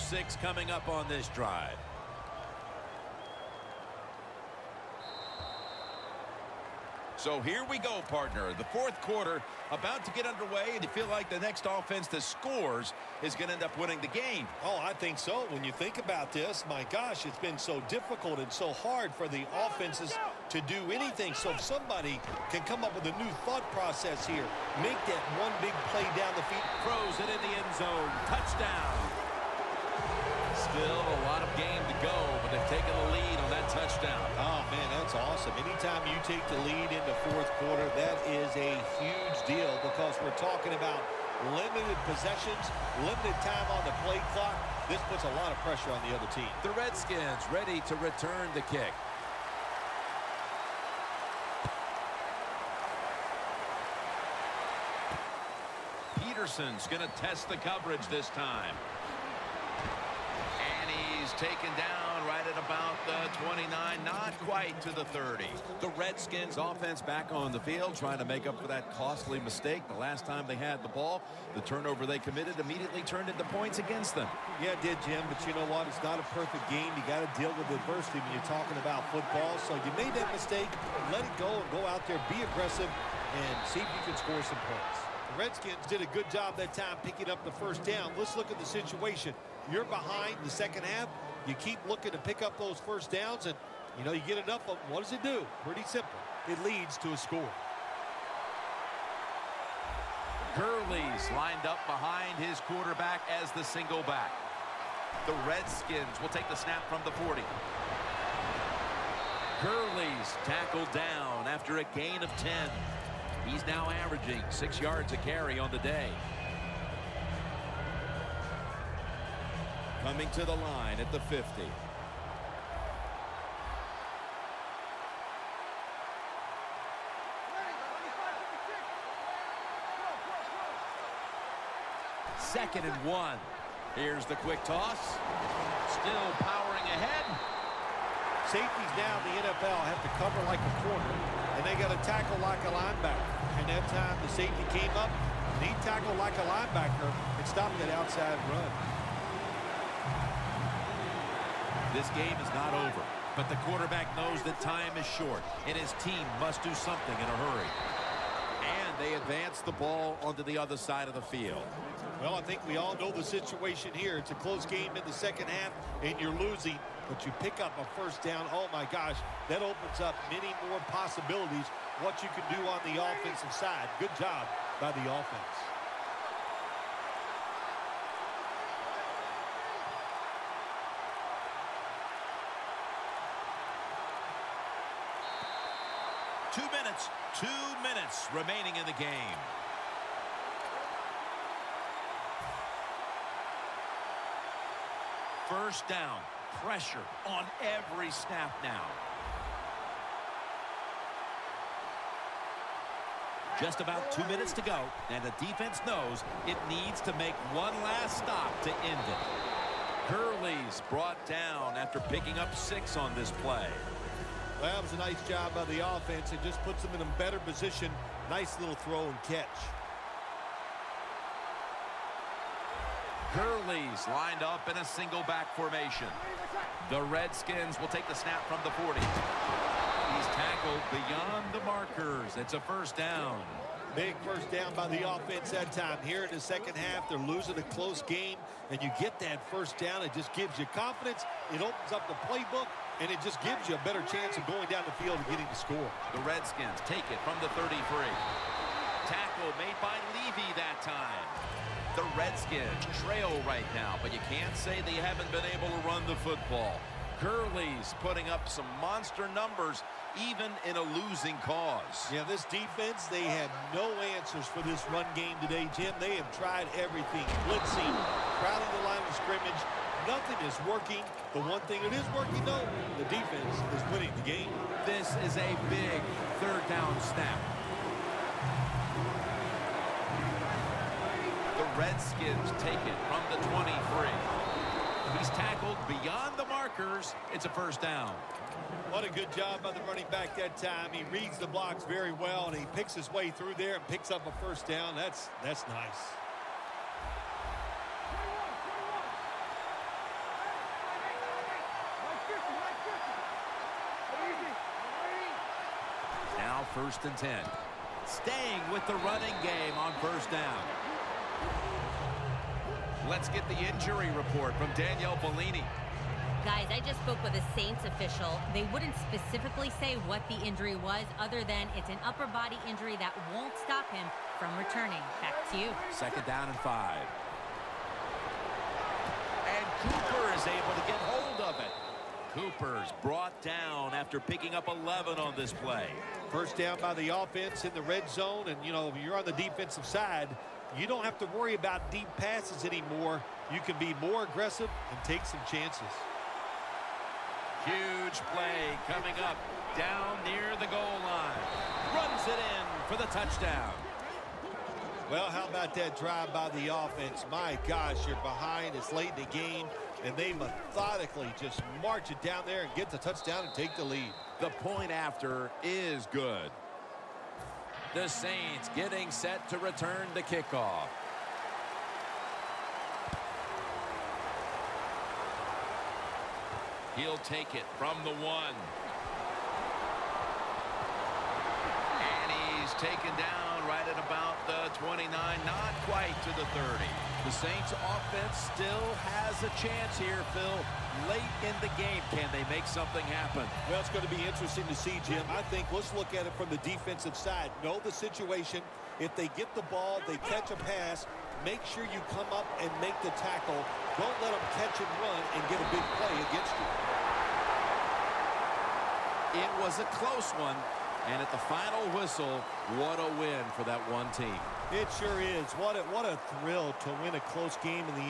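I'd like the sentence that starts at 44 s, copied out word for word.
This puts a lot of pressure on the other team.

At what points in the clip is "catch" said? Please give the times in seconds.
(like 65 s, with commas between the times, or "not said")
219 s, 400 s, 404 s.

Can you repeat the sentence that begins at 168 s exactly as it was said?
Oh, my gosh, that opens up many more possibilities, what you can do on the offensive side.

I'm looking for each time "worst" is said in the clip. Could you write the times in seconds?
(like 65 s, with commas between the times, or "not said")
not said.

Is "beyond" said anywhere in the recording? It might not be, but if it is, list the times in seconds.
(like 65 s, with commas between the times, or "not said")
230 s, 285 s.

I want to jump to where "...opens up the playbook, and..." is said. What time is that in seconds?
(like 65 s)
241 s.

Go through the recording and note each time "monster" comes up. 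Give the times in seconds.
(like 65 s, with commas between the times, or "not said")
258 s.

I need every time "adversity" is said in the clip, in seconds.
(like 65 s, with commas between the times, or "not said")
77 s.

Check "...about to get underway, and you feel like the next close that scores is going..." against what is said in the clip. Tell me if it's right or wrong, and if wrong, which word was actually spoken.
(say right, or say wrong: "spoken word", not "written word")
wrong: "offense", not "close".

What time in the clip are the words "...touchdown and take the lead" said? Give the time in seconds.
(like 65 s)
362 s.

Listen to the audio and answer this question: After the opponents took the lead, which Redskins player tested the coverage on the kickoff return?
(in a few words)
Peterson.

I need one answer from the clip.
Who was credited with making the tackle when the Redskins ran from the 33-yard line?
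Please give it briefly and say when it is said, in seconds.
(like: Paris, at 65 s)
Levy, at 250 s.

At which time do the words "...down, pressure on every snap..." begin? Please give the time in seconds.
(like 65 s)
195 s.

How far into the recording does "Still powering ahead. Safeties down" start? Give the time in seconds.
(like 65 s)
135 s.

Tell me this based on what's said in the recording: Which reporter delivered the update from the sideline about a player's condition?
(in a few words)
Danielle Bellini.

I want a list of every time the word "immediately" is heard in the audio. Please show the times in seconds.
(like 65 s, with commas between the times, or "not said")
72 s.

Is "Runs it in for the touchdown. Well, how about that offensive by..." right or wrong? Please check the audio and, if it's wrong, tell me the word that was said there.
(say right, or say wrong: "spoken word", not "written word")
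wrong: "drive", not "offensive".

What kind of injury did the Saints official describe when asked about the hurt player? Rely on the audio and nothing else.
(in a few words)
Upper body injury.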